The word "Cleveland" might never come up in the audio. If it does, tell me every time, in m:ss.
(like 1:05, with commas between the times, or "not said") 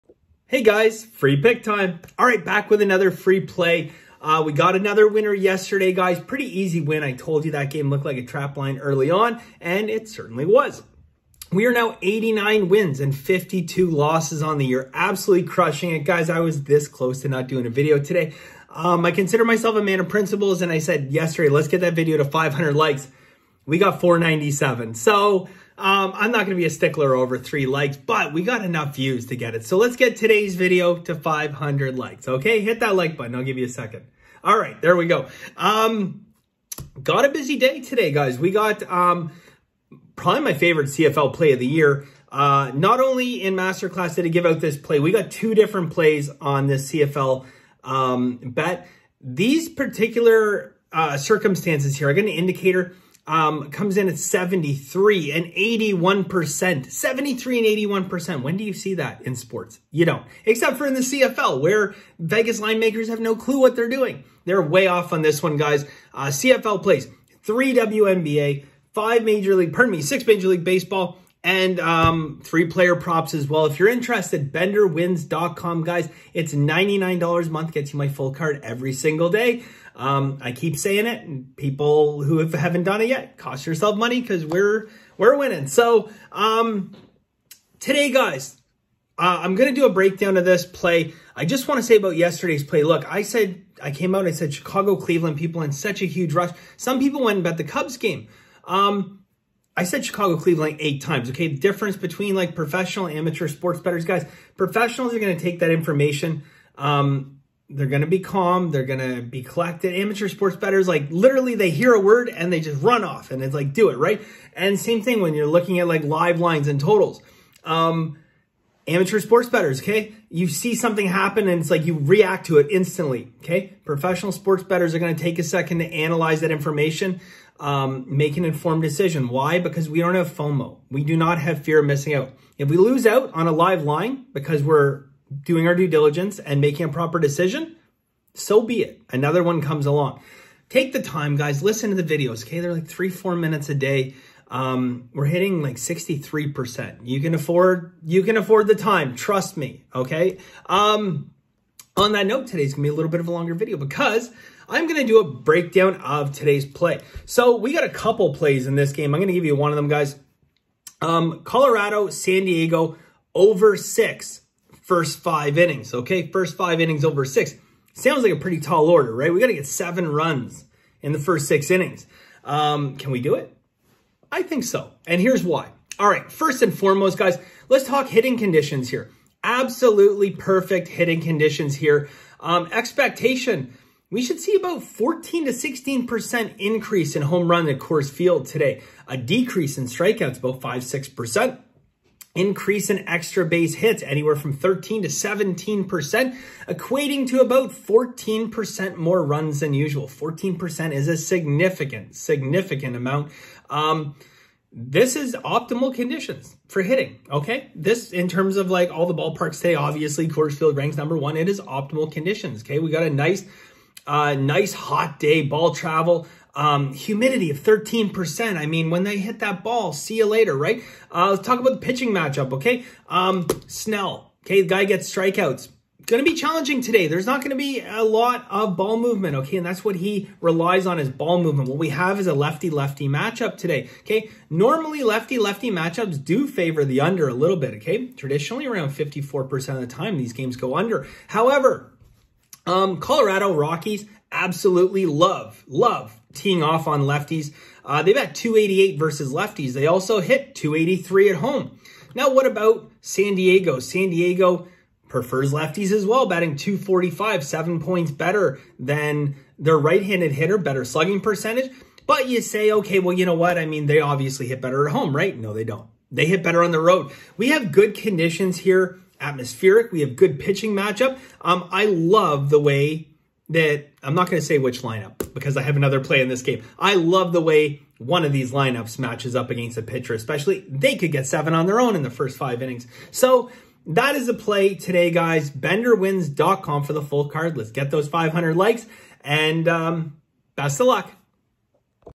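1:34, 1:40.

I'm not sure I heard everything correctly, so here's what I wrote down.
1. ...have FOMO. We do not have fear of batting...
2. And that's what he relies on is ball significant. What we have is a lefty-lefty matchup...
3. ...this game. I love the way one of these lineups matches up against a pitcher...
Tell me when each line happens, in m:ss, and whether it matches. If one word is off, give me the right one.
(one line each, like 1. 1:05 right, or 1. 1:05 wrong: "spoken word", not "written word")
1. 2:10 wrong: "missing", not "batting"
2. 3:49 wrong: "movement", not "significant"
3. 4:36 right.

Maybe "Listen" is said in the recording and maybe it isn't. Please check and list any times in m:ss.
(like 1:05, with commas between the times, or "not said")
2:21.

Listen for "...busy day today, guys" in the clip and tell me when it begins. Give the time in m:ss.
0:37.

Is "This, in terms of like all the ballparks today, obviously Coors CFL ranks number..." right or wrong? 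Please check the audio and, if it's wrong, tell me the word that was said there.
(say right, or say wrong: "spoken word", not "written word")
wrong: "Field", not "CFL".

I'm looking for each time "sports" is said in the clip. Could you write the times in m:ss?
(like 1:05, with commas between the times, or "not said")
0:59, 1:43, 1:50, 1:59, 2:04.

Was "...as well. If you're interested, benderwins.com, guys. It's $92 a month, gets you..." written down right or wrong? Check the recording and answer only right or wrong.
wrong.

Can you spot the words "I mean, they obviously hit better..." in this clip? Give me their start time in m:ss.
4:23.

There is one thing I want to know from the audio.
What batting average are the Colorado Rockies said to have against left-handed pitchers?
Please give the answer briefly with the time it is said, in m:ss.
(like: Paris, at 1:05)
288, at 4:08.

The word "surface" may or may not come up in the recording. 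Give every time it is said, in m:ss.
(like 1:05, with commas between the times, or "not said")
not said.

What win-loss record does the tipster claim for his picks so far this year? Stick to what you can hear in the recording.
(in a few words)
89-52.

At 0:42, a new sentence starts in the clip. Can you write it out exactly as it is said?
Uh, not only in Masterclass did I give out this play, we got two different plays on this CFL um, bet.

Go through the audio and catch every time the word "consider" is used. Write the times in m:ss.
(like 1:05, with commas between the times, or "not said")
0:19.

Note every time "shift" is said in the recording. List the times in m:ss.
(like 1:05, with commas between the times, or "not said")
not said.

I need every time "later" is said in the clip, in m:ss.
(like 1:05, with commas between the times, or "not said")
3:40.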